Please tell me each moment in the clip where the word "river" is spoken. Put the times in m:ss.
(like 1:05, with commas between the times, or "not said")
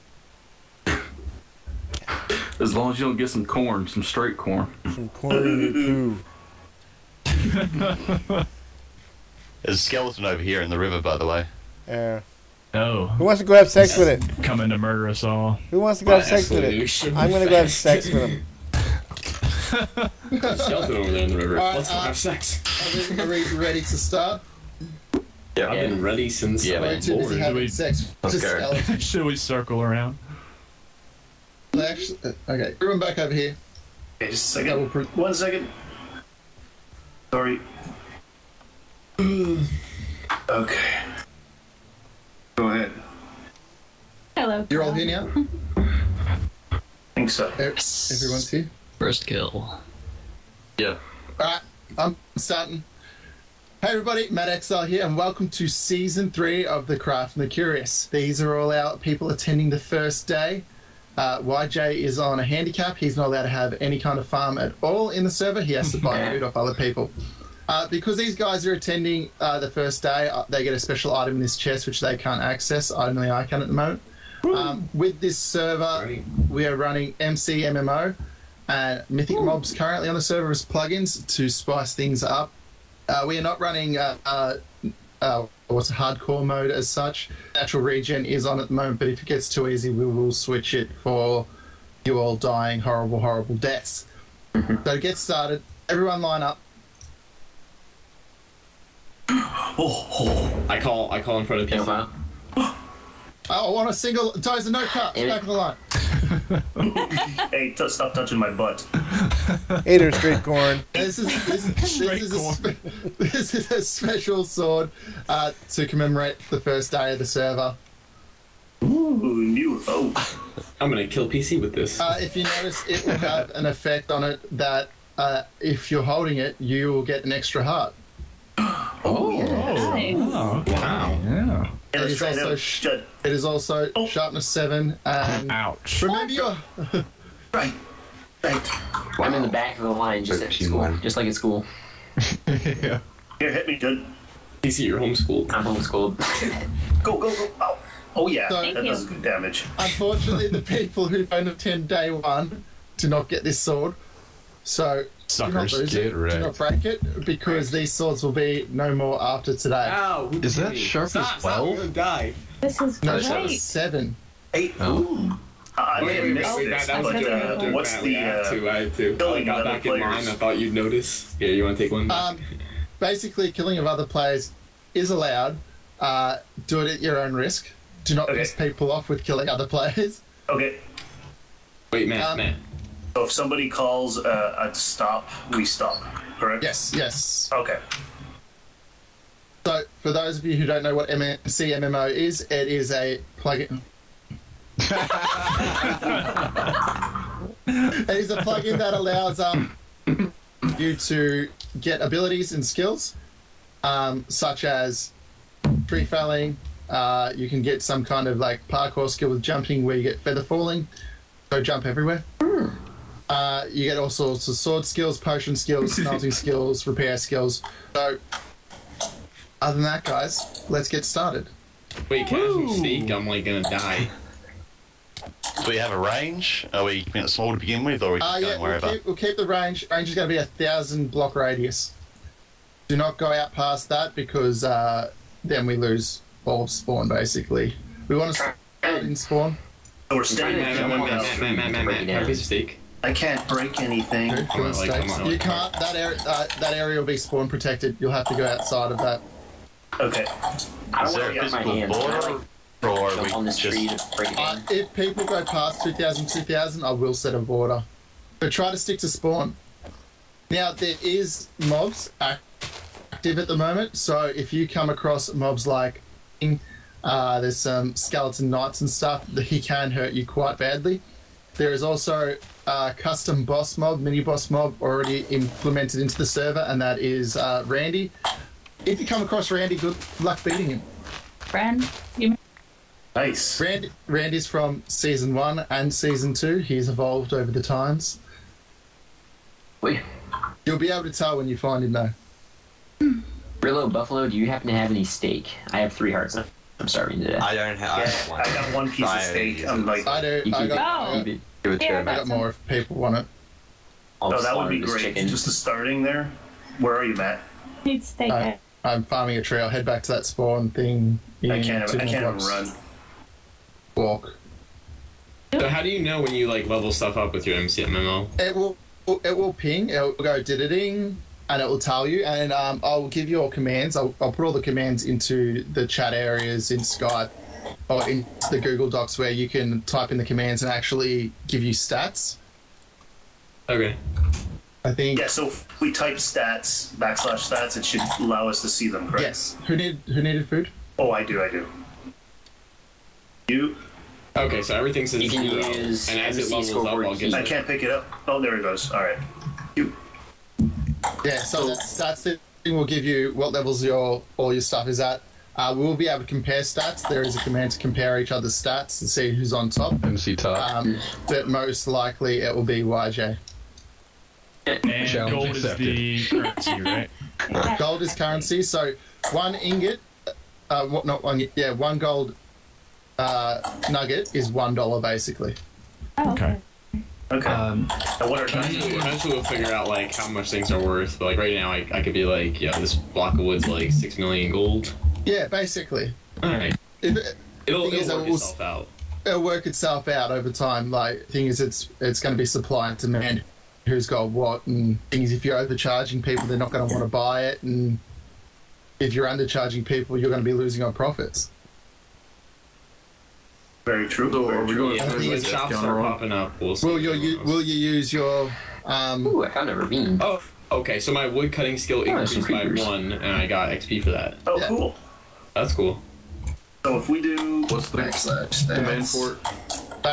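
0:10, 0:21.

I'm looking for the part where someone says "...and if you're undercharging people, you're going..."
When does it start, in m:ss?
6:37.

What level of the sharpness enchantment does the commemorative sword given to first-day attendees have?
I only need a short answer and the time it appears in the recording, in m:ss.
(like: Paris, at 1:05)
7, at 2:14.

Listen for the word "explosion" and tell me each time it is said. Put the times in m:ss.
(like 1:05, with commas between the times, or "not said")
not said.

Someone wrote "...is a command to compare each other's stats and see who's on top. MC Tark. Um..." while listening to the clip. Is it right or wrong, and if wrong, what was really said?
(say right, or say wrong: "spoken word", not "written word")
right.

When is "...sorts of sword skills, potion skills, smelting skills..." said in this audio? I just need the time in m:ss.
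3:34.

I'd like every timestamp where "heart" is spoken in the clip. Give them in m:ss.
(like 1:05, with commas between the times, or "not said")
2:07, 4:56.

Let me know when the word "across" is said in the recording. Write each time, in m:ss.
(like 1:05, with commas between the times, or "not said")
4:24, 4:39.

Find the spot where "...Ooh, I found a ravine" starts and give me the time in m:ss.
6:49.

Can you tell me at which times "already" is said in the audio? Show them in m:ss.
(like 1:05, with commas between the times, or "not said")
4:34.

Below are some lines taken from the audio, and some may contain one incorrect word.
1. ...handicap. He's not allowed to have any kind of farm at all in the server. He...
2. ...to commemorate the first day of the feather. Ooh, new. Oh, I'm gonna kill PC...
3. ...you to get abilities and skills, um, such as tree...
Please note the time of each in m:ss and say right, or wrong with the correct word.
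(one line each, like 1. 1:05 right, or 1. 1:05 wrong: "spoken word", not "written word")
1. 1:02 right
2. 1:55 wrong: "server", not "feather"
3. 3:20 right.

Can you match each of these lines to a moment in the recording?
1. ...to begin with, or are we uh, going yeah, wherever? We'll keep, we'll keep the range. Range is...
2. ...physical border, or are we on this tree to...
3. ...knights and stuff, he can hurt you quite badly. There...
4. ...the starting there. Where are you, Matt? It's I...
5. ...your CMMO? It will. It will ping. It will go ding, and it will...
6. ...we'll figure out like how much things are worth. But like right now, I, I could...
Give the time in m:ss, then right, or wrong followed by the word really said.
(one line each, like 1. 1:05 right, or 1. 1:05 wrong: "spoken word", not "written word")
1. 3:47 right
2. 4:11 right
3. 4:28 right
4. 5:05 right
5. 5:17 wrong: "MCMMO", not "CMMO"
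6. 6:19 right.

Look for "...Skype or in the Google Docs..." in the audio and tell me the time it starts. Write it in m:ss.
5:26.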